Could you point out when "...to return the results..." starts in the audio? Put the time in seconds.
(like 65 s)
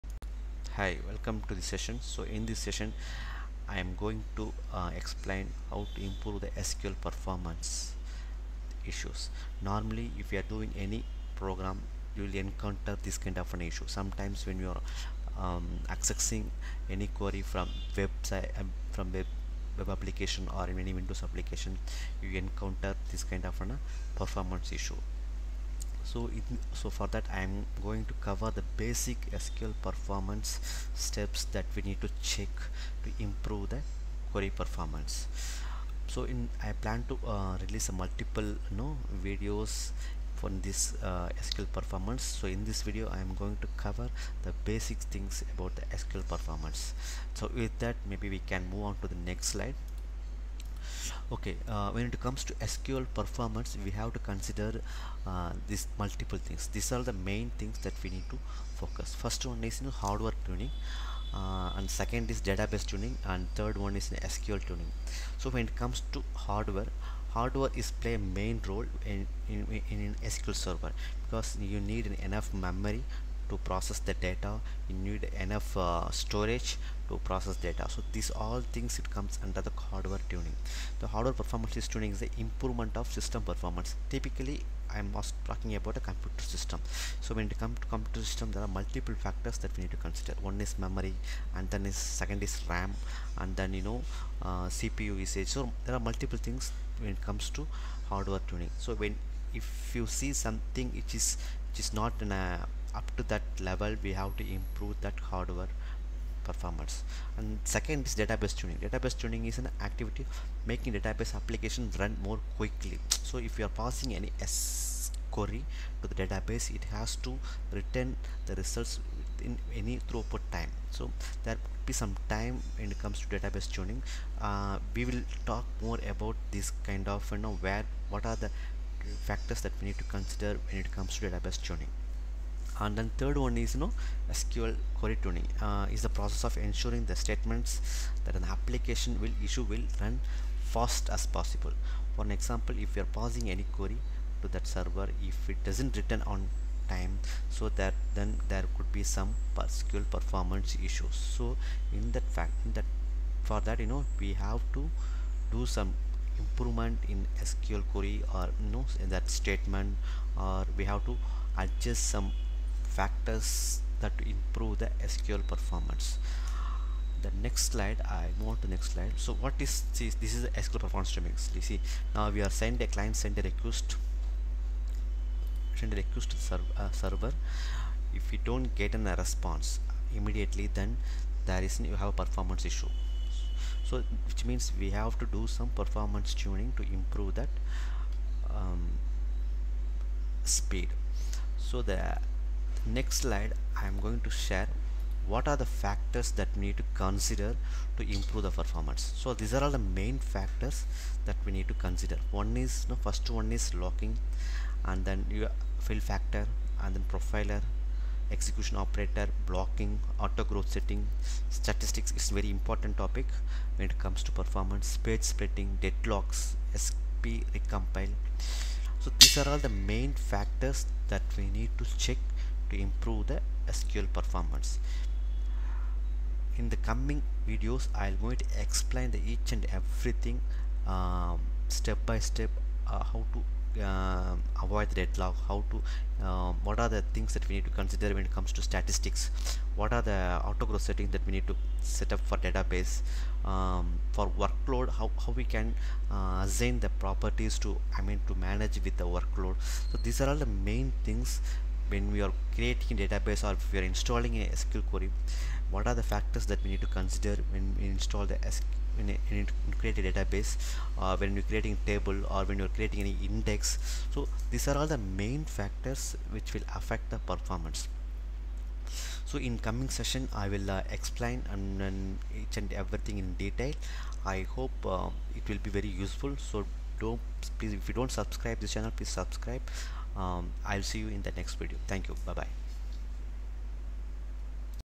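117 s.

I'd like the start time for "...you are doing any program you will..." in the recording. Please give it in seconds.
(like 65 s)
10 s.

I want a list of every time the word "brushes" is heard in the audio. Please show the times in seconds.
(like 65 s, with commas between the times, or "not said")
not said.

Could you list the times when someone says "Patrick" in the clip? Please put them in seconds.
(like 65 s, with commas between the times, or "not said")
not said.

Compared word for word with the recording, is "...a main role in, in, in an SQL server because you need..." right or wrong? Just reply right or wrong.
right.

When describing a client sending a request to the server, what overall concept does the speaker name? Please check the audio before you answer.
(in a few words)
SQL performance metrics.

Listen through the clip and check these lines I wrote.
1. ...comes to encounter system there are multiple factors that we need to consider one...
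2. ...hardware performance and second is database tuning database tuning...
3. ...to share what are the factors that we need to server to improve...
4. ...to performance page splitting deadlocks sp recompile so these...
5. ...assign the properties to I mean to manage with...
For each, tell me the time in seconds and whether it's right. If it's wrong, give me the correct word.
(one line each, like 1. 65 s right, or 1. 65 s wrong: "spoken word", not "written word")
1. 87 s wrong: "computer", not "encounter"
2. 105 s right
3. 194 s wrong: "consider", not "server"
4. 214 s right
5. 246 s right.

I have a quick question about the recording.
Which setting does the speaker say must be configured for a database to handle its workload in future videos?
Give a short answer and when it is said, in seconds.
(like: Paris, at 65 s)
Auto growth settings, at 240 s.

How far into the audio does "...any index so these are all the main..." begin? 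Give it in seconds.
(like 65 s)
263 s.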